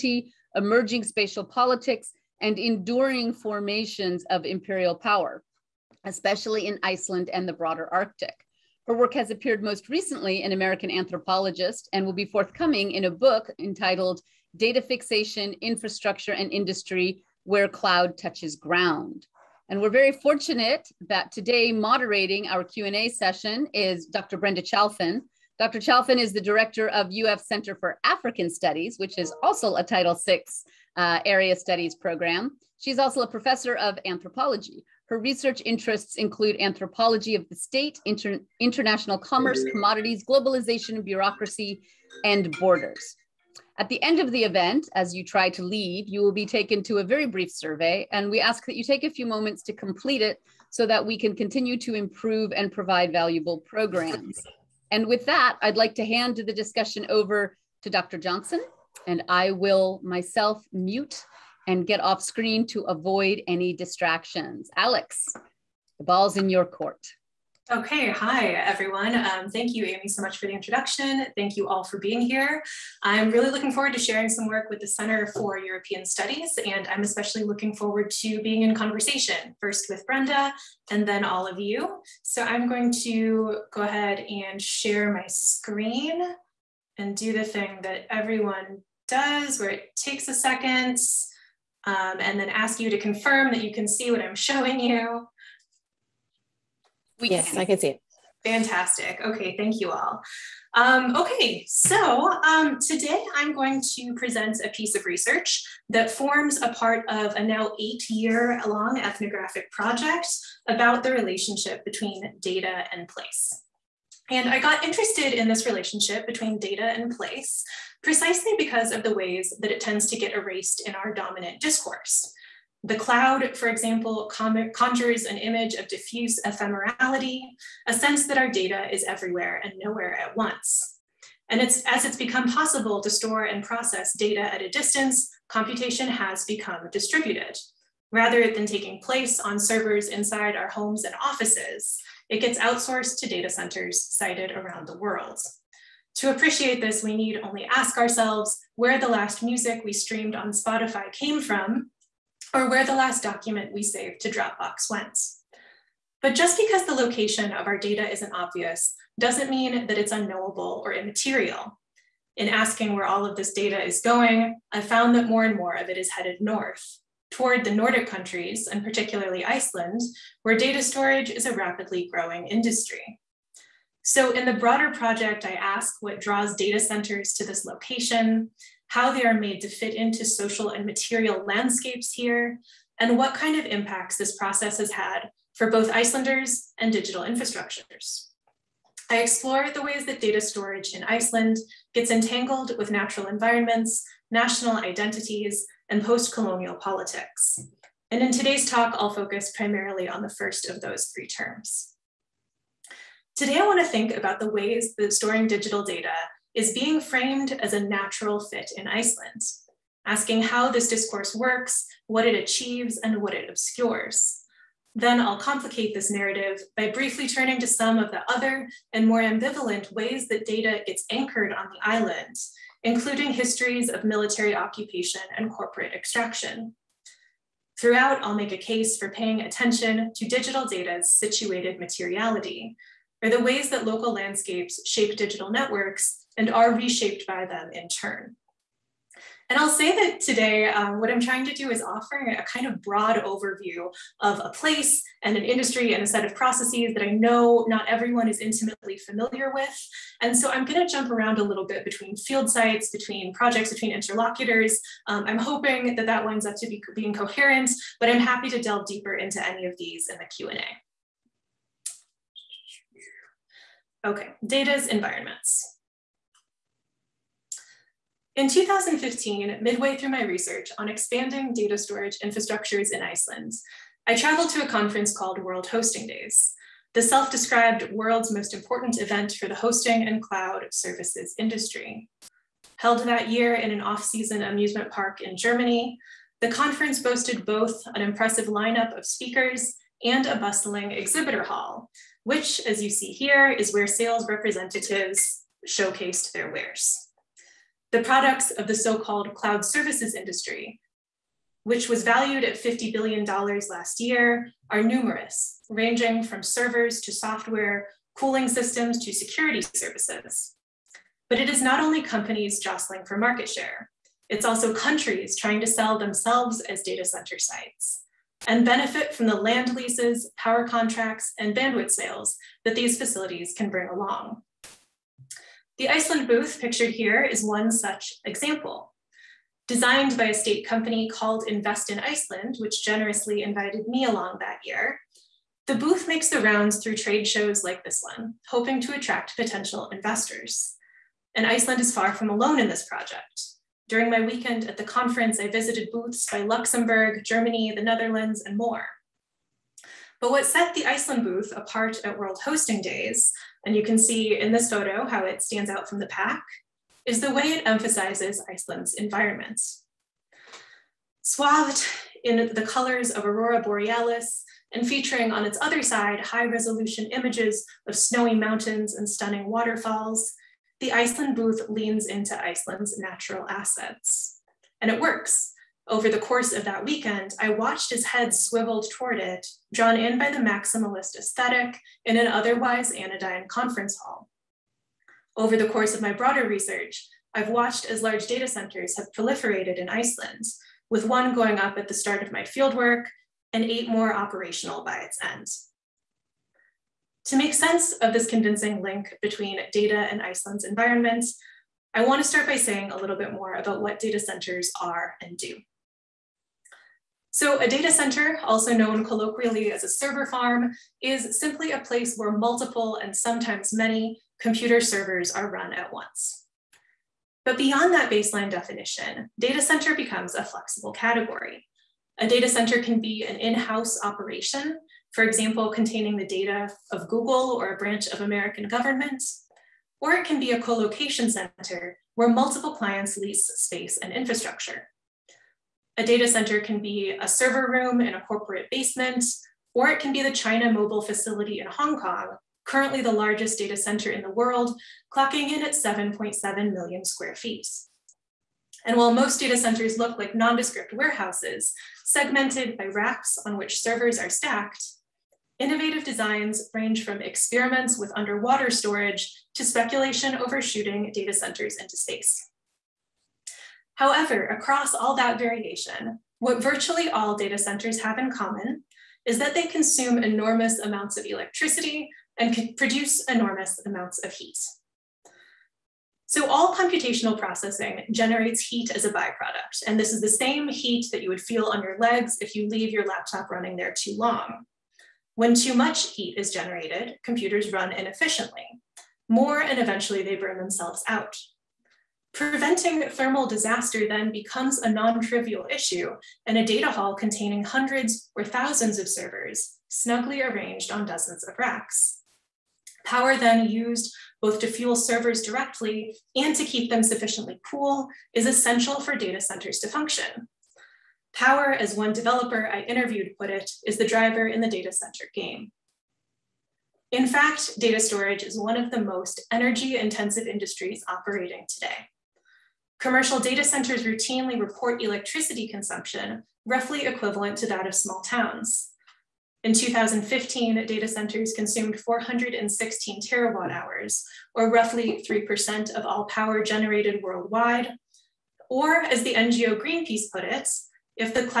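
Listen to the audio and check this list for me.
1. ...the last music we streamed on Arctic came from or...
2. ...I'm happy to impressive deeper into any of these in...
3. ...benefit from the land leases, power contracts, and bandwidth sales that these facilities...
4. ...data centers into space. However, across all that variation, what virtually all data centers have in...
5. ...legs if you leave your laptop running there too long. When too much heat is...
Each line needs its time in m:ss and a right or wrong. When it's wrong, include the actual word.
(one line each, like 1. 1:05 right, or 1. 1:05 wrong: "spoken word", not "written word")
1. 2:28 wrong: "Spotify", not "Arctic"
2. 4:18 wrong: "delve", not "impressive"
3. 5:18 right
4. 7:41 right
5. 8:01 right.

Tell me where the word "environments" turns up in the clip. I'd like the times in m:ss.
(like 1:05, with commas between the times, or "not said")
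3:13, 4:24, 5:58, 6:40.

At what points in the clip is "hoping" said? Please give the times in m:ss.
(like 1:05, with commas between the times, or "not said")
4:15, 5:38.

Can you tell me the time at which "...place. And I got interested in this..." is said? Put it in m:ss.
1:53.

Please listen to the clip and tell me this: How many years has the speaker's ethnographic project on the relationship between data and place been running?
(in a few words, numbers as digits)
8.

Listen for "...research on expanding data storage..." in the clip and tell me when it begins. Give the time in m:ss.
4:30.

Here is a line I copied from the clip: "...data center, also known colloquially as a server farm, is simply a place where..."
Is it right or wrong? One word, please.
right.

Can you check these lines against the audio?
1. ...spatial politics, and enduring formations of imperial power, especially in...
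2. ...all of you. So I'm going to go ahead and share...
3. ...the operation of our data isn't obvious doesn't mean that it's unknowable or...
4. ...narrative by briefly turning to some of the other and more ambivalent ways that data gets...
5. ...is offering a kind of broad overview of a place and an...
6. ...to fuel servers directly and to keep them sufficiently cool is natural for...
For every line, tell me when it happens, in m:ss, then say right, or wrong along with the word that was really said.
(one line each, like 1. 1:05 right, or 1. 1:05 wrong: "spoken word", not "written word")
1. 0:01 right
2. 1:21 right
3. 2:36 wrong: "location", not "operation"
4. 3:36 right
5. 4:01 right
6. 8:24 wrong: "essential", not "natural".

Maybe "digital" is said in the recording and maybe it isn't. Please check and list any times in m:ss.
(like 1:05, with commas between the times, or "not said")
3:06, 3:25, 3:50, 3:55.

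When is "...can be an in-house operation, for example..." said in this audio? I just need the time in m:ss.
7:02.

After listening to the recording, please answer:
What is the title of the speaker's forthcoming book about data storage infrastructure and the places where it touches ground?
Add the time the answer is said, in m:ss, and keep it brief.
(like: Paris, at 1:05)
Data Fixation, at 0:14.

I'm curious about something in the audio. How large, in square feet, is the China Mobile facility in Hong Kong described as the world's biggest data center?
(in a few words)
7.7 million square feet.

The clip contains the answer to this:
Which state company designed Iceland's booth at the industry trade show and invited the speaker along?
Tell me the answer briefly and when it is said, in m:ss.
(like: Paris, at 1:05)
Invest in Iceland, at 5:31.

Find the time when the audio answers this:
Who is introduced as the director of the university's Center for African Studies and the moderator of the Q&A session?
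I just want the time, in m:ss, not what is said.
0:24.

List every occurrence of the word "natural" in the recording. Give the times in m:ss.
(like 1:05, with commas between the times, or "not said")
3:12, 3:27, 6:12.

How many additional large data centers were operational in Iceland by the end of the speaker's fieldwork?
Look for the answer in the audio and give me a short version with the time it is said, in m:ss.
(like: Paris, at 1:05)
8, at 6:33.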